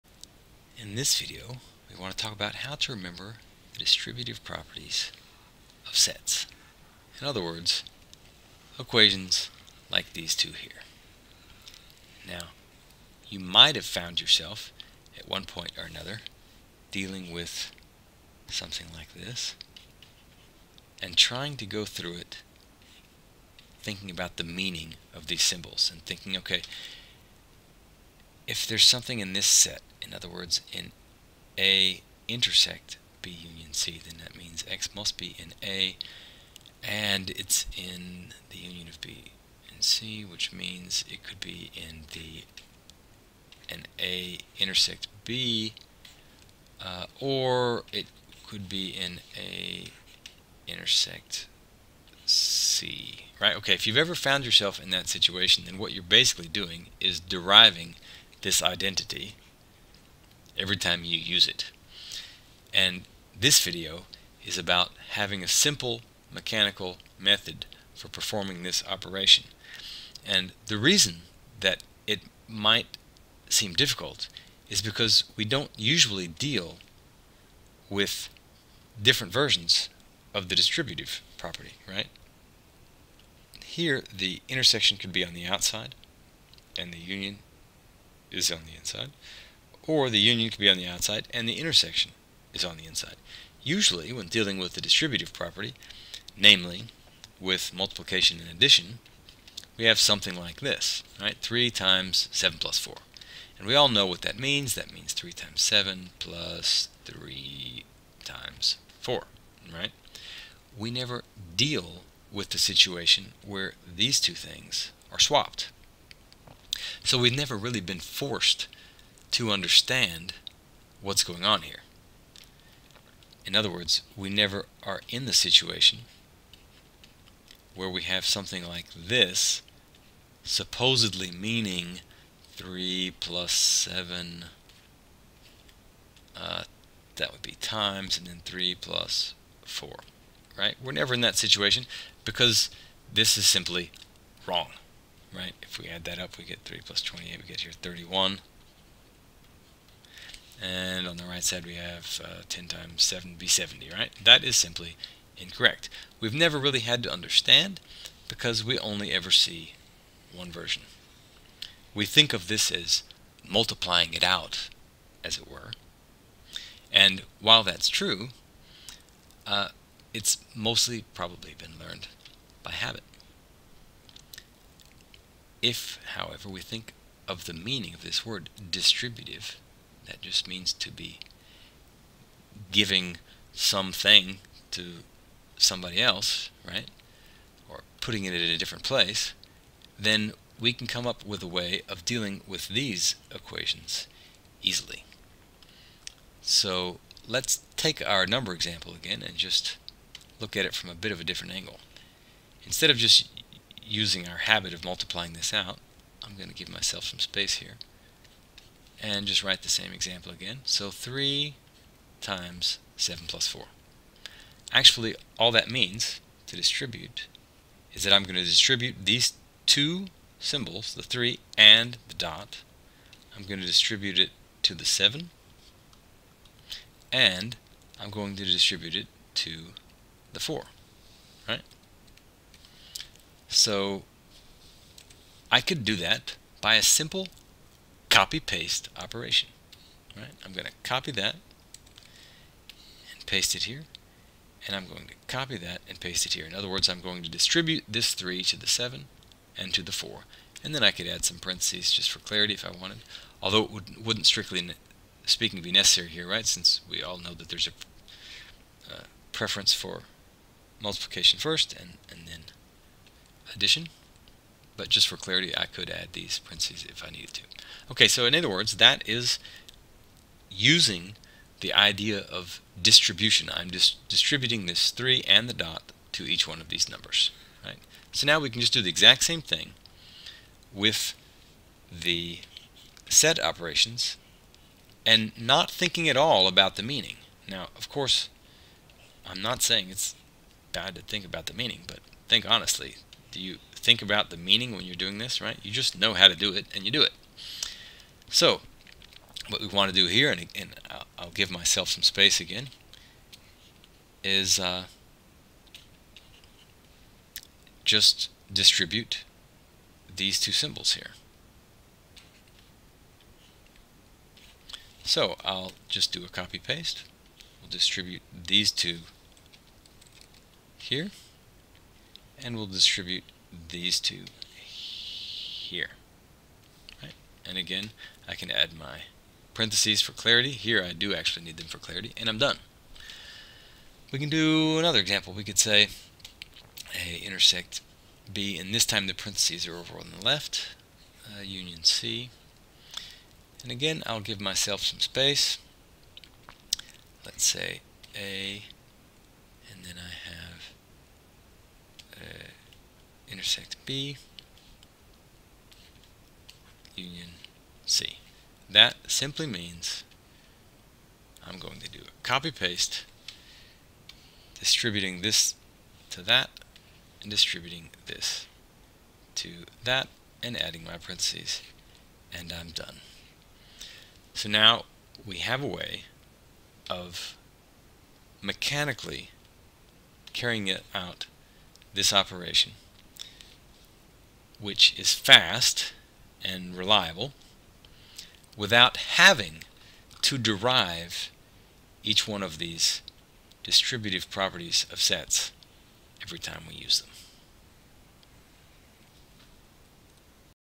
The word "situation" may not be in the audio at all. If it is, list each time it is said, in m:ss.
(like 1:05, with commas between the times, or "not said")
0:55, 1:52, 2:05, 2:21.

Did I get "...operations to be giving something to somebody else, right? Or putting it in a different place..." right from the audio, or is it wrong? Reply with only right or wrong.
wrong.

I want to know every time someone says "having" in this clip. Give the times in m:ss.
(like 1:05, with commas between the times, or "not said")
1:05, 6:29.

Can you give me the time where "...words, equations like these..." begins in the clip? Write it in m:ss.
0:07.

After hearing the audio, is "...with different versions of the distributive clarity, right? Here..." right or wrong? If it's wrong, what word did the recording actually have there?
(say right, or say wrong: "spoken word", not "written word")
wrong: "property", not "clarity".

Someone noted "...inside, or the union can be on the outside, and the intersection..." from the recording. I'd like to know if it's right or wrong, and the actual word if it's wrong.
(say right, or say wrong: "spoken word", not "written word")
right.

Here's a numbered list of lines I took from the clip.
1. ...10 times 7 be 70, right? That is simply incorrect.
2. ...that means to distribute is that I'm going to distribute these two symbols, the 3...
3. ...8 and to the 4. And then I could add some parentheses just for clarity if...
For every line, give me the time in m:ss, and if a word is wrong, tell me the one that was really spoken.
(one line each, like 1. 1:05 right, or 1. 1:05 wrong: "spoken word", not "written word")
1. 2:32 right
2. 3:35 right
3. 4:08 wrong: "7", not "8".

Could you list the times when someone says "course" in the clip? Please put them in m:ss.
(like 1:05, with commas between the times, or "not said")
4:47.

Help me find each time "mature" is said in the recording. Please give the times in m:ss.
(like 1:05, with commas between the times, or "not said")
not said.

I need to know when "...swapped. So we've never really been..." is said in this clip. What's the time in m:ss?
1:55.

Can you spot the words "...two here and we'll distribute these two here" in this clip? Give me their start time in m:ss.
5:18.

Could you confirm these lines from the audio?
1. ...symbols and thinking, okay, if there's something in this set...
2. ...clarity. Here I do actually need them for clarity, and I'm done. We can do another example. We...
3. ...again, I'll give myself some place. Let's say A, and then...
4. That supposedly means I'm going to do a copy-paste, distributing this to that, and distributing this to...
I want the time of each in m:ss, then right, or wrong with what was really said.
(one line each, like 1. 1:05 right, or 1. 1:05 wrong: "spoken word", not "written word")
1. 0:25 right
2. 5:30 right
3. 5:43 wrong: "space", not "place"
4. 5:58 wrong: "simply", not "supposedly".